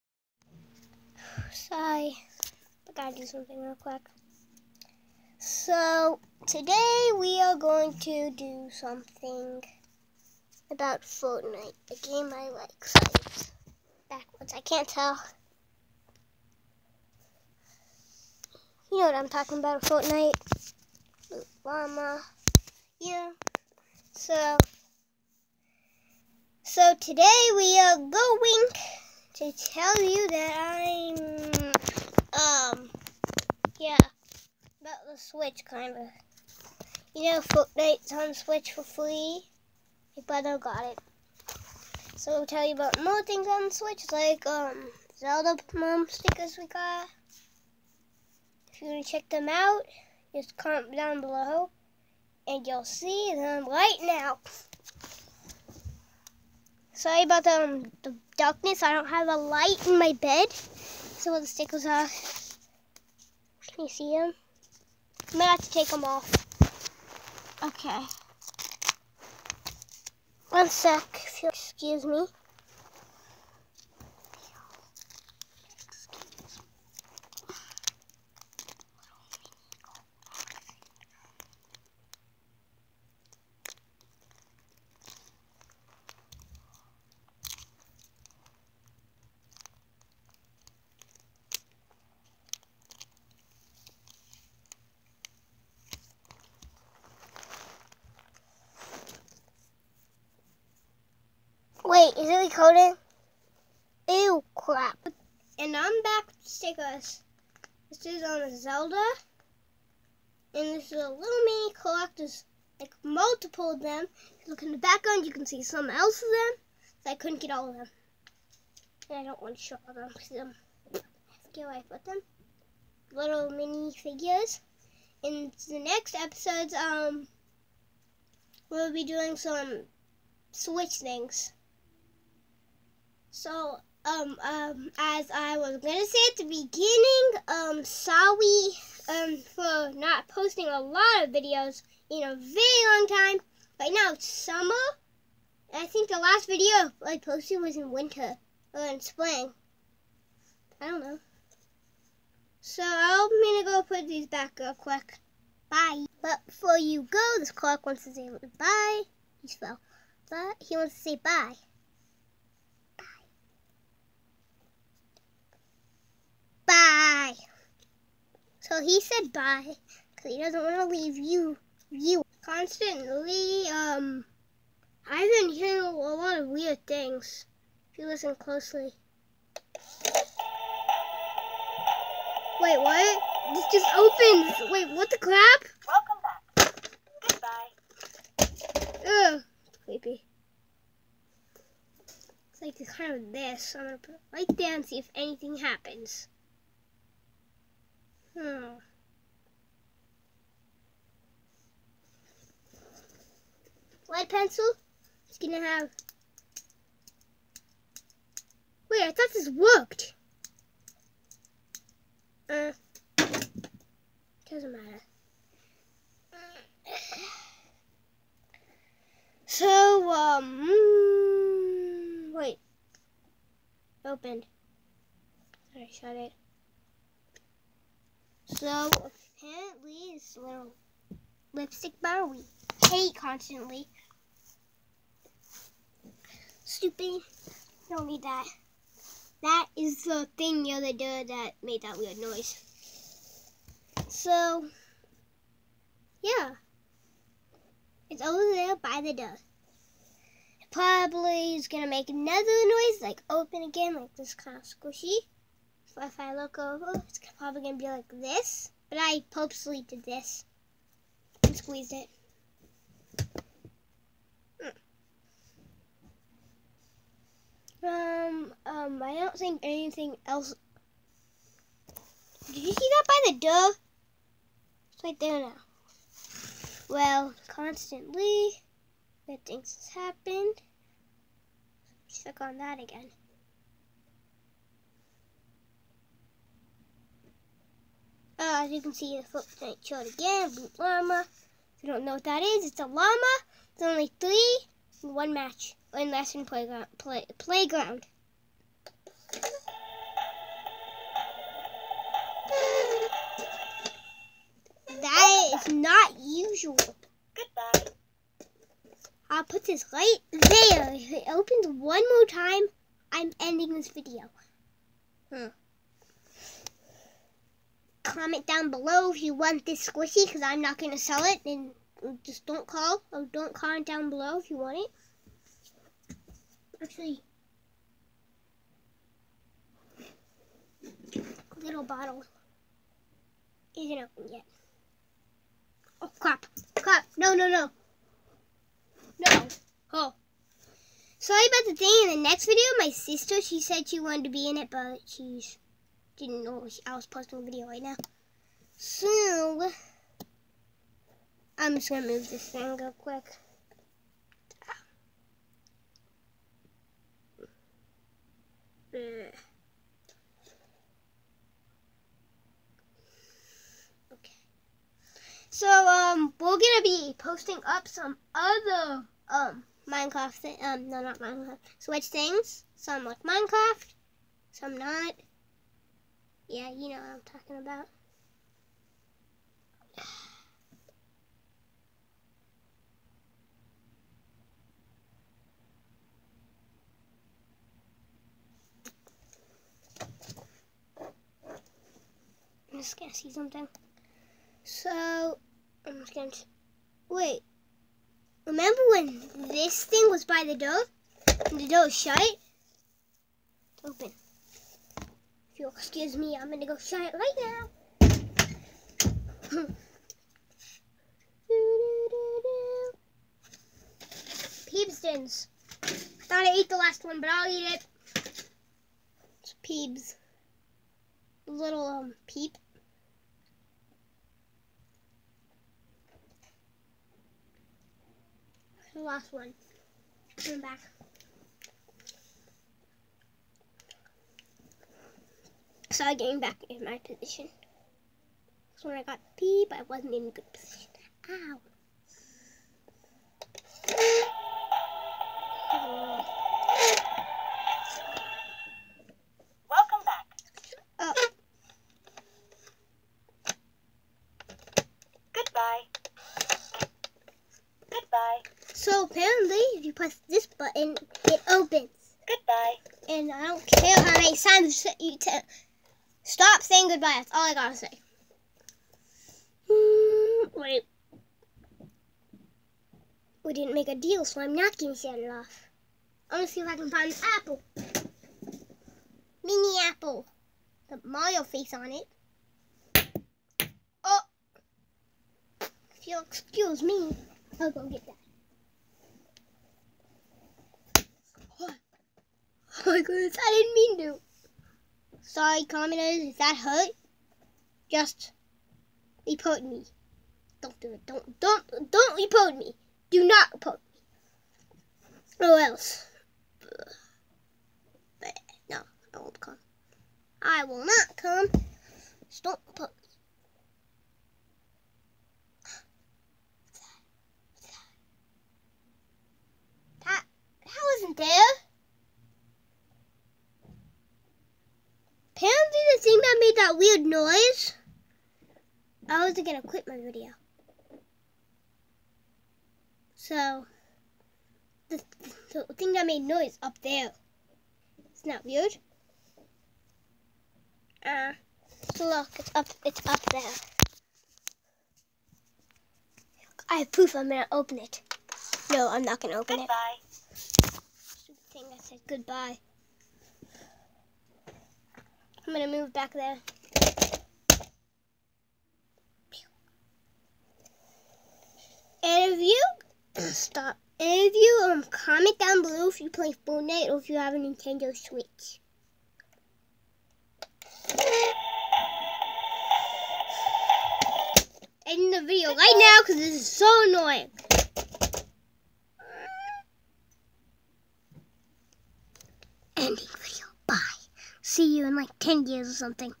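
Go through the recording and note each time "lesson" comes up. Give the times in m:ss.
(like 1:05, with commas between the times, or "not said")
4:56.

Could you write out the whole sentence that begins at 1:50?
And this is a little mini collector's, like multiple of them.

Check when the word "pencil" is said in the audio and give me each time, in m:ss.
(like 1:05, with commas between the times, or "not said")
3:24.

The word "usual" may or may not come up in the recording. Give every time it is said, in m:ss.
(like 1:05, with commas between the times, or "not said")
5:06.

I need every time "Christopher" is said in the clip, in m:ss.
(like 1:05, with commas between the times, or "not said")
not said.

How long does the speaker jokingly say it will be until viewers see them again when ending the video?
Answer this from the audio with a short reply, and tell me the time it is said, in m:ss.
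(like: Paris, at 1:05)
10 years, at 9:45.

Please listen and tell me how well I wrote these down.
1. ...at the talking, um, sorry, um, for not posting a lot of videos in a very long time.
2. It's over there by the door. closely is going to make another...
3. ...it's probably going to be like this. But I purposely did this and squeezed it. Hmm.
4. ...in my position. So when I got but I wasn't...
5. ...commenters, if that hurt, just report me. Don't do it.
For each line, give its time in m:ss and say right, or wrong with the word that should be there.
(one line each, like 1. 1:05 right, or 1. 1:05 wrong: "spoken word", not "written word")
1. 2:16 wrong: "beginning", not "talking"
2. 4:08 wrong: "probably", not "closely"
3. 4:17 right
4. 7:16 right
5. 8:15 right.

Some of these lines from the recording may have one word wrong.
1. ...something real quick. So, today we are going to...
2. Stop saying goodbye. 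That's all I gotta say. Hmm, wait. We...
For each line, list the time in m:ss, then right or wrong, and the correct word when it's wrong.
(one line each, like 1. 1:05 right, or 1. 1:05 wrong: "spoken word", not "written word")
1. 0:03 right
2. 7:46 right.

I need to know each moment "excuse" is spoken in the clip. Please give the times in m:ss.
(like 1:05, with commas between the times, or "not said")
1:11, 6:45, 8:06.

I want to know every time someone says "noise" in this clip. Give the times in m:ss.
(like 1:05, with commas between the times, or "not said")
4:02, 4:12, 8:47, 8:56.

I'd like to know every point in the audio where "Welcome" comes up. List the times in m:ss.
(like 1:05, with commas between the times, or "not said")
3:05, 7:29.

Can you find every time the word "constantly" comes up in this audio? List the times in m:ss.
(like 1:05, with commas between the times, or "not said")
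2:52, 3:53, 4:37.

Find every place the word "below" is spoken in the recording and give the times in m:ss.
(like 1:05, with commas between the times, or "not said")
0:51, 5:18, 5:24, 9:25.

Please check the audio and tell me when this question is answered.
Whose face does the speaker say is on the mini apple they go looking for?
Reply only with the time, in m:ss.
8:01.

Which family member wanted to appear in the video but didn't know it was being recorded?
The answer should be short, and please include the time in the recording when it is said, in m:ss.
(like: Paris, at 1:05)
Sister, at 5:42.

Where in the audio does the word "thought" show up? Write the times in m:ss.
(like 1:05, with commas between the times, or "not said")
3:29, 6:56.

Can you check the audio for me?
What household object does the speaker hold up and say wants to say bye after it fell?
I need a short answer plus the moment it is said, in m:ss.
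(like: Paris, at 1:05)
Clock, at 2:37.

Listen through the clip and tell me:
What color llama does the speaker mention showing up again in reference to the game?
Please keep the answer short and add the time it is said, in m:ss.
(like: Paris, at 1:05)
Blue, at 4:50.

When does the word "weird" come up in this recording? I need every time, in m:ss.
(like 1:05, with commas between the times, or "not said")
2:56, 4:01, 8:46, 8:58.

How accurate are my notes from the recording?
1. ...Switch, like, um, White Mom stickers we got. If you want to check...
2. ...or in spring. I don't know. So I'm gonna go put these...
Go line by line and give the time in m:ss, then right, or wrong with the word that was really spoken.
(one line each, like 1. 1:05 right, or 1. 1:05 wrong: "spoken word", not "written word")
1. 0:43 wrong: "Zelda", not "White"
2. 2:28 right.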